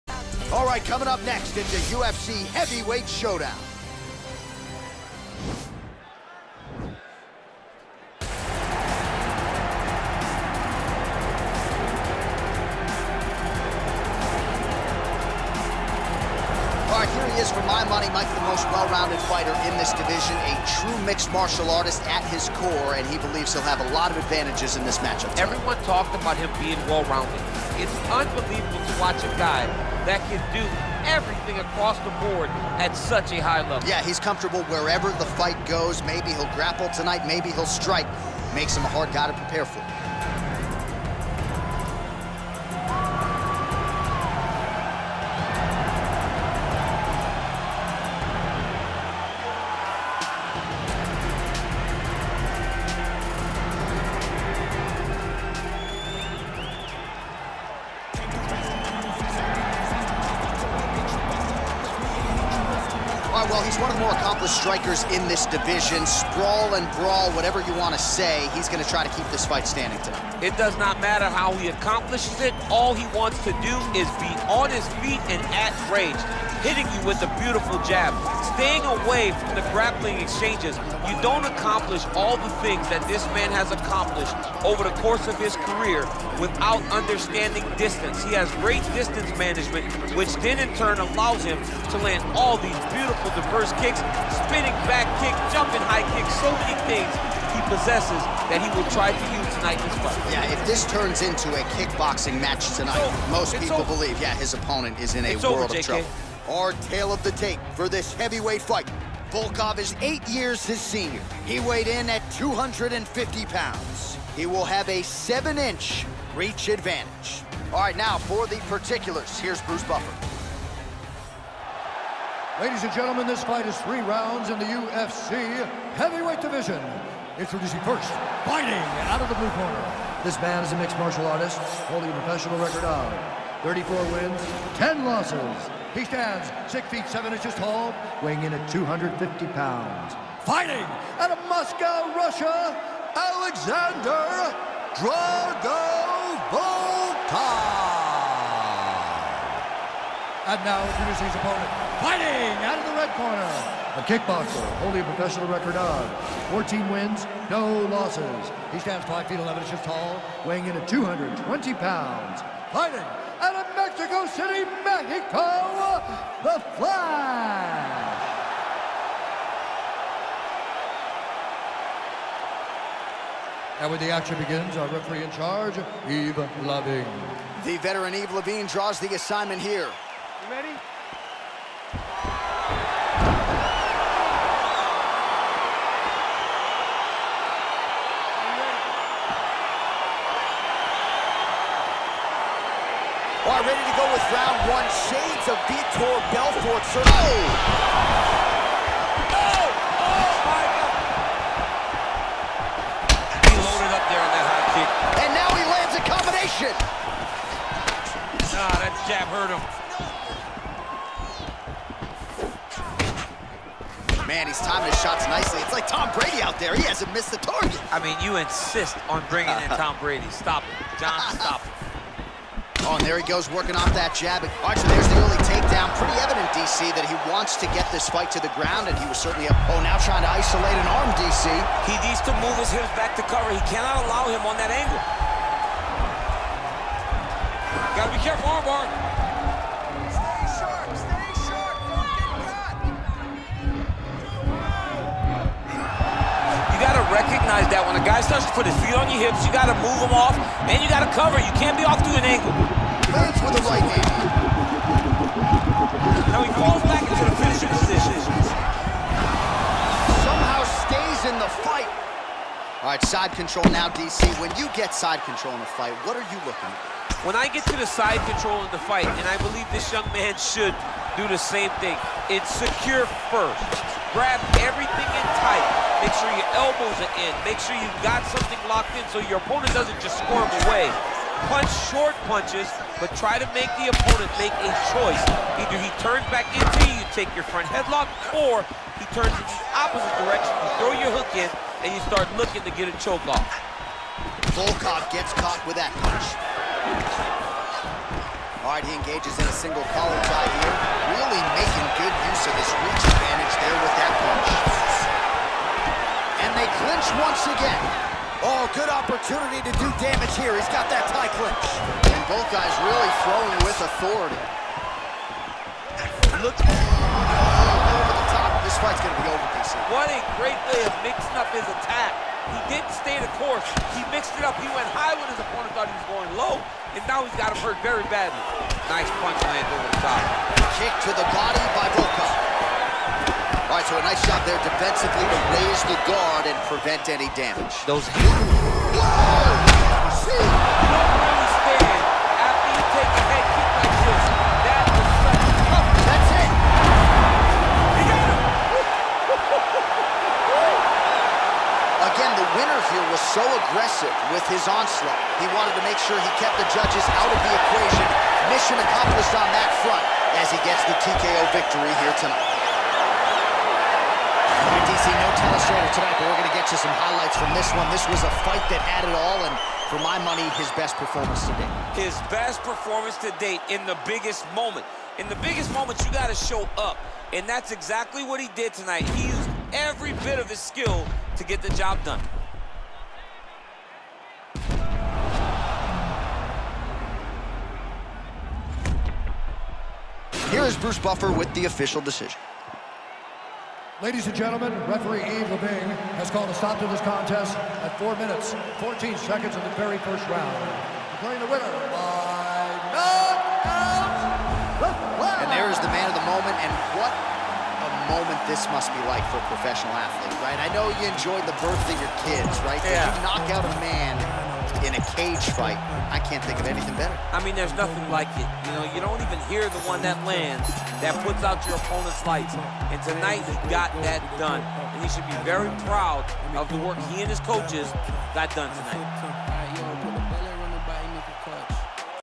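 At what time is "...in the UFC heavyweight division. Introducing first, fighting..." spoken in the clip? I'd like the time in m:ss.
2:04.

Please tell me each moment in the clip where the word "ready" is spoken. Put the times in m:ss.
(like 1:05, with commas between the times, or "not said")
3:00, 3:13.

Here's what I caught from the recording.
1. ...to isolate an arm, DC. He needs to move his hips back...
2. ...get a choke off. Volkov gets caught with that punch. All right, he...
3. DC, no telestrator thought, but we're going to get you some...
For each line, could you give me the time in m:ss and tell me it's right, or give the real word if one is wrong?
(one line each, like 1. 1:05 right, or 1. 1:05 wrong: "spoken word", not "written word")
1. 3:50 right
2. 4:52 right
3. 6:04 wrong: "tonight", not "thought".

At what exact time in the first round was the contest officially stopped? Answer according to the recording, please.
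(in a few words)
4:14.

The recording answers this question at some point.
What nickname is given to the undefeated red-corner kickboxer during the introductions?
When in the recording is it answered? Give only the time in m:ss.
2:46.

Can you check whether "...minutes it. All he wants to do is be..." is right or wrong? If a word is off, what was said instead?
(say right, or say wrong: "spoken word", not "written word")
wrong: "accomplishes", not "minutes".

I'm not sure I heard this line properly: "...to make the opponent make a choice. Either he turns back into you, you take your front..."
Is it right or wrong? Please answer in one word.
right.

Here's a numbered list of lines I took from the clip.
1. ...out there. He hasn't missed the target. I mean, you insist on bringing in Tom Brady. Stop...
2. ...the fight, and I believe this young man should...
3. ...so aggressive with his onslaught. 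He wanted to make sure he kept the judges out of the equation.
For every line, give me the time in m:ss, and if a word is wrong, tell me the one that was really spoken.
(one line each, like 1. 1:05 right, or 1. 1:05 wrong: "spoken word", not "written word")
1. 3:36 right
2. 4:28 right
3. 5:53 right.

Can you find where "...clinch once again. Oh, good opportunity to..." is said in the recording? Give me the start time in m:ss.
5:06.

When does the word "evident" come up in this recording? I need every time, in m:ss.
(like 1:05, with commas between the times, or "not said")
3:46.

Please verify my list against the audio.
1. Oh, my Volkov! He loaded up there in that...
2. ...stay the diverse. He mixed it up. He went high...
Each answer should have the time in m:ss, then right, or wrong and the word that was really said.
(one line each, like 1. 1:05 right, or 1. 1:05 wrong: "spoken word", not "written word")
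1. 3:19 wrong: "God", not "Volkov"
2. 5:22 wrong: "course", not "diverse".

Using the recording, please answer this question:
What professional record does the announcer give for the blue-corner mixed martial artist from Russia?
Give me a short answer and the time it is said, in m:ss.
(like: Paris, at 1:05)
34 wins, 10 losses, at 2:13.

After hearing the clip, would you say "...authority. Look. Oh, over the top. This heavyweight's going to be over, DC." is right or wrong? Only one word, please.
wrong.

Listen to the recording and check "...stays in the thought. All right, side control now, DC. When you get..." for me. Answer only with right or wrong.
wrong.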